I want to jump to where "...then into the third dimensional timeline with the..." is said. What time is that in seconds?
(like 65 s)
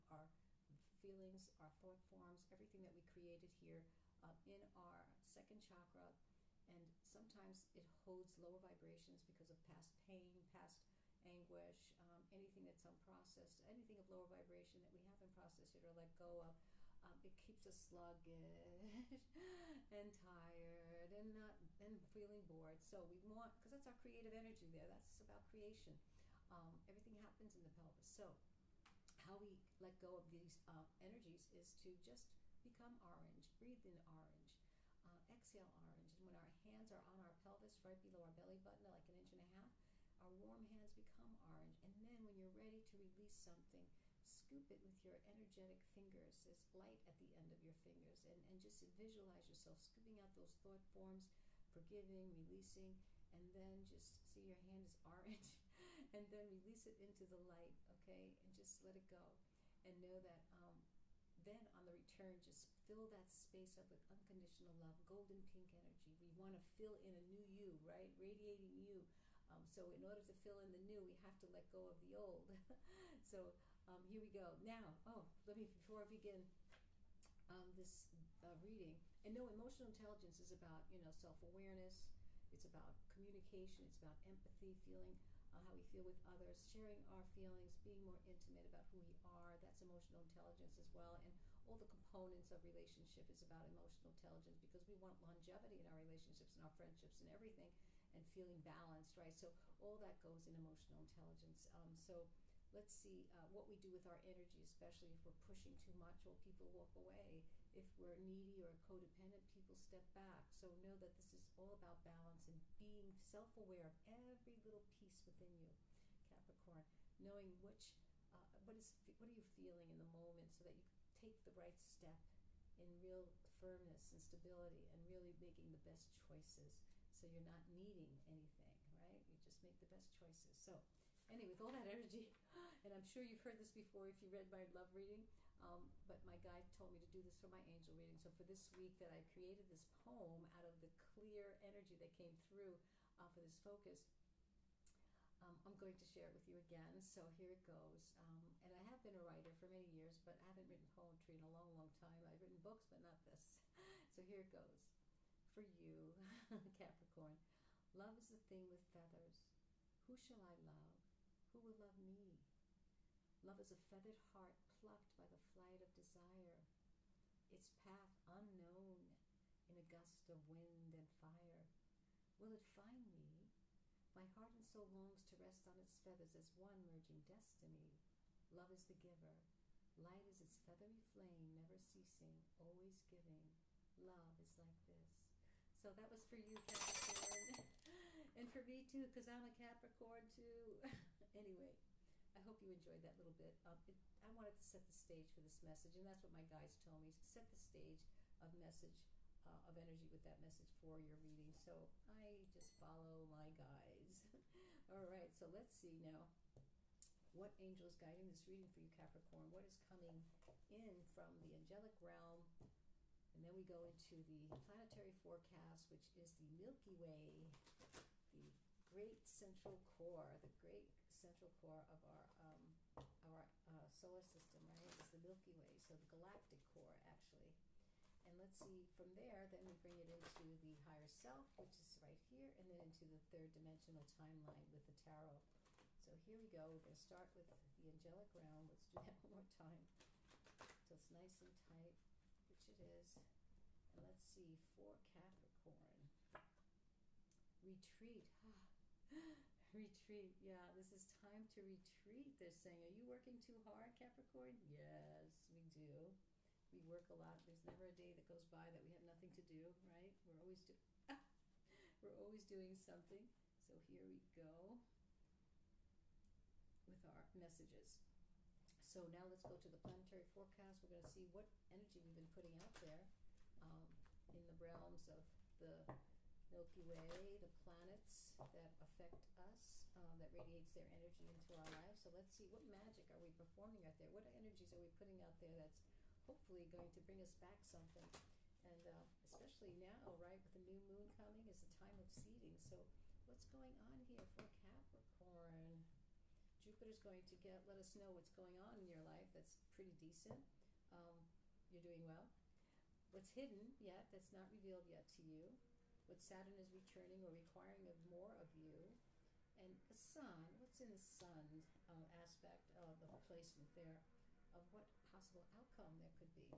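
232 s.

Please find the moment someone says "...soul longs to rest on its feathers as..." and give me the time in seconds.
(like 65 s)
174 s.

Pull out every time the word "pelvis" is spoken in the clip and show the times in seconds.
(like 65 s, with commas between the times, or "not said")
27 s, 37 s.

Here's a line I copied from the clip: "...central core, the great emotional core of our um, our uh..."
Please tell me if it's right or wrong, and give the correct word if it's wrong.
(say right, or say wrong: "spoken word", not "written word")
wrong: "central", not "emotional".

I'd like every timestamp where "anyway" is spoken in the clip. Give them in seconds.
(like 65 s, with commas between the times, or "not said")
131 s, 191 s.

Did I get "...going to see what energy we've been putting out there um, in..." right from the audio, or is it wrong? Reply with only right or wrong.
right.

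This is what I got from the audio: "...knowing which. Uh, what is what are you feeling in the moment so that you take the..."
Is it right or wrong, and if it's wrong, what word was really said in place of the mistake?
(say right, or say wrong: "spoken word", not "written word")
right.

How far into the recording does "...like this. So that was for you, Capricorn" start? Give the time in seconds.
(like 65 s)
184 s.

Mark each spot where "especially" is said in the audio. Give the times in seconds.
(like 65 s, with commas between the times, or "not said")
104 s, 289 s.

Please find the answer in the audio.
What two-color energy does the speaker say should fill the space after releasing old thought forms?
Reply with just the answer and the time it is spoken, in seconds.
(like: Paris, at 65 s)
golden pink, at 65 s.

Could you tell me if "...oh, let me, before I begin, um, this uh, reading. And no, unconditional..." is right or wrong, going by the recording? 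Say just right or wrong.
wrong.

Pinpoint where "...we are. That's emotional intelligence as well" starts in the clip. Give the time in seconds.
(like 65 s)
88 s.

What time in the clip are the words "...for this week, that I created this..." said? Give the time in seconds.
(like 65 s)
138 s.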